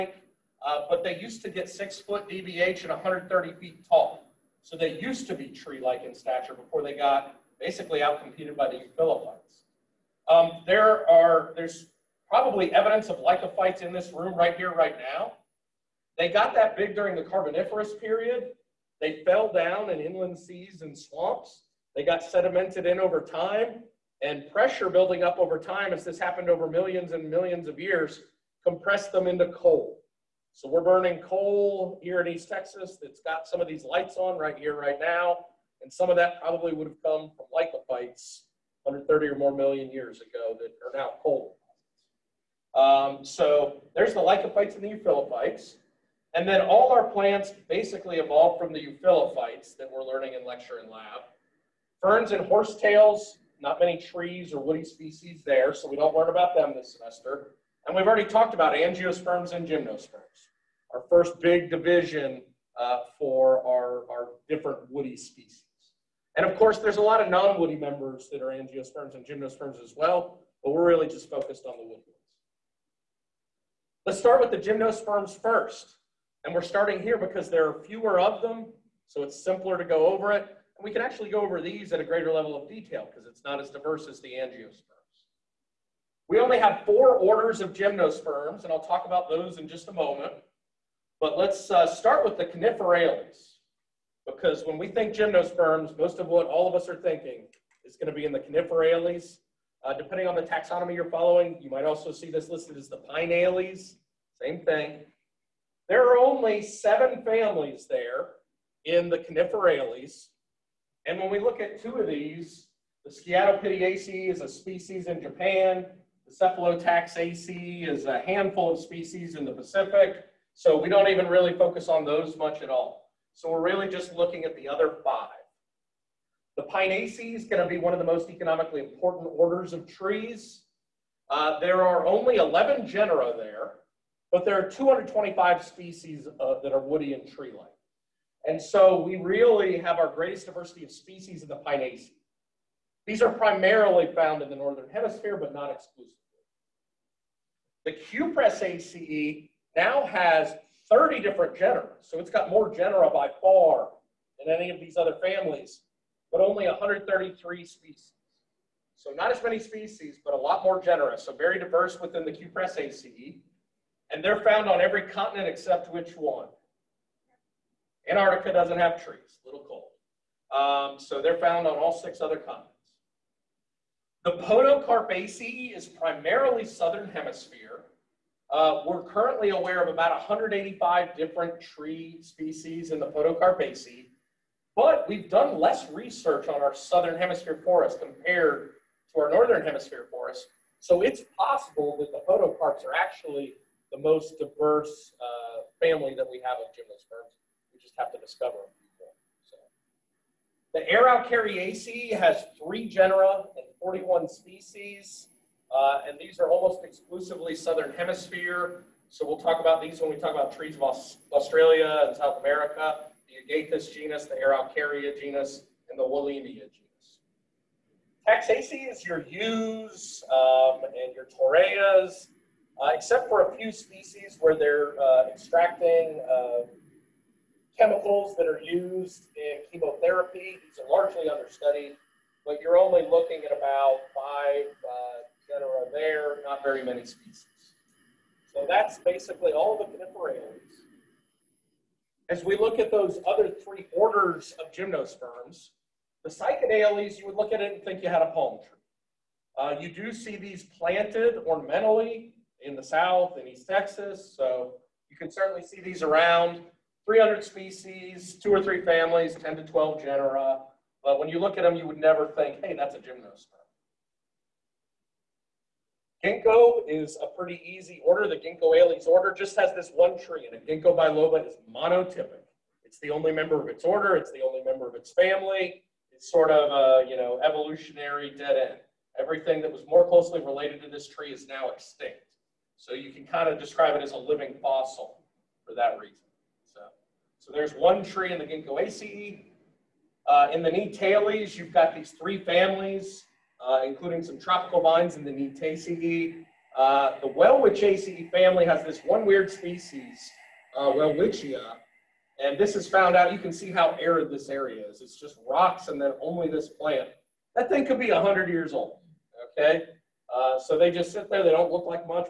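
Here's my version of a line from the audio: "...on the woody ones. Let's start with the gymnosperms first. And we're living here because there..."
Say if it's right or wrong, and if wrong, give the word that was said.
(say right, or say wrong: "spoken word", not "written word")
wrong: "starting", not "living".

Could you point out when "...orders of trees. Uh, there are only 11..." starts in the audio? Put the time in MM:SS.
02:09.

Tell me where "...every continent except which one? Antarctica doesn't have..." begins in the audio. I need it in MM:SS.
02:44.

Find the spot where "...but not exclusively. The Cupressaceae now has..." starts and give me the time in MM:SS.
02:25.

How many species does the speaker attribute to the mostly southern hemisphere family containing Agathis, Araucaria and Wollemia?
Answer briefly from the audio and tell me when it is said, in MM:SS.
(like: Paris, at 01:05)
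41, at 03:23.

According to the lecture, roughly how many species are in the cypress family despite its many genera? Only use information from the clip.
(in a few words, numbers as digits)
133.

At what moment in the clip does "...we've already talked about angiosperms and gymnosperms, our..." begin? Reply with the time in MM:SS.
00:57.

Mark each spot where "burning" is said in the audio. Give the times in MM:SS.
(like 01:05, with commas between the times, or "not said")
00:30.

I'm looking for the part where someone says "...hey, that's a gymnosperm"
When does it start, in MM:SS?
04:22.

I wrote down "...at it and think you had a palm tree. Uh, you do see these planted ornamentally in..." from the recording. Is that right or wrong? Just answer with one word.
right.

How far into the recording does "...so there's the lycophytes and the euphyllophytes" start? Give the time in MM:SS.
00:43.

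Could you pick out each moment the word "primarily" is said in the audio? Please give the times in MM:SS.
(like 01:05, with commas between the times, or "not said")
02:23, 02:55.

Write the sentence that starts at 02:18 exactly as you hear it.
And so we really have our greatest diversity of species in the Pinaceae.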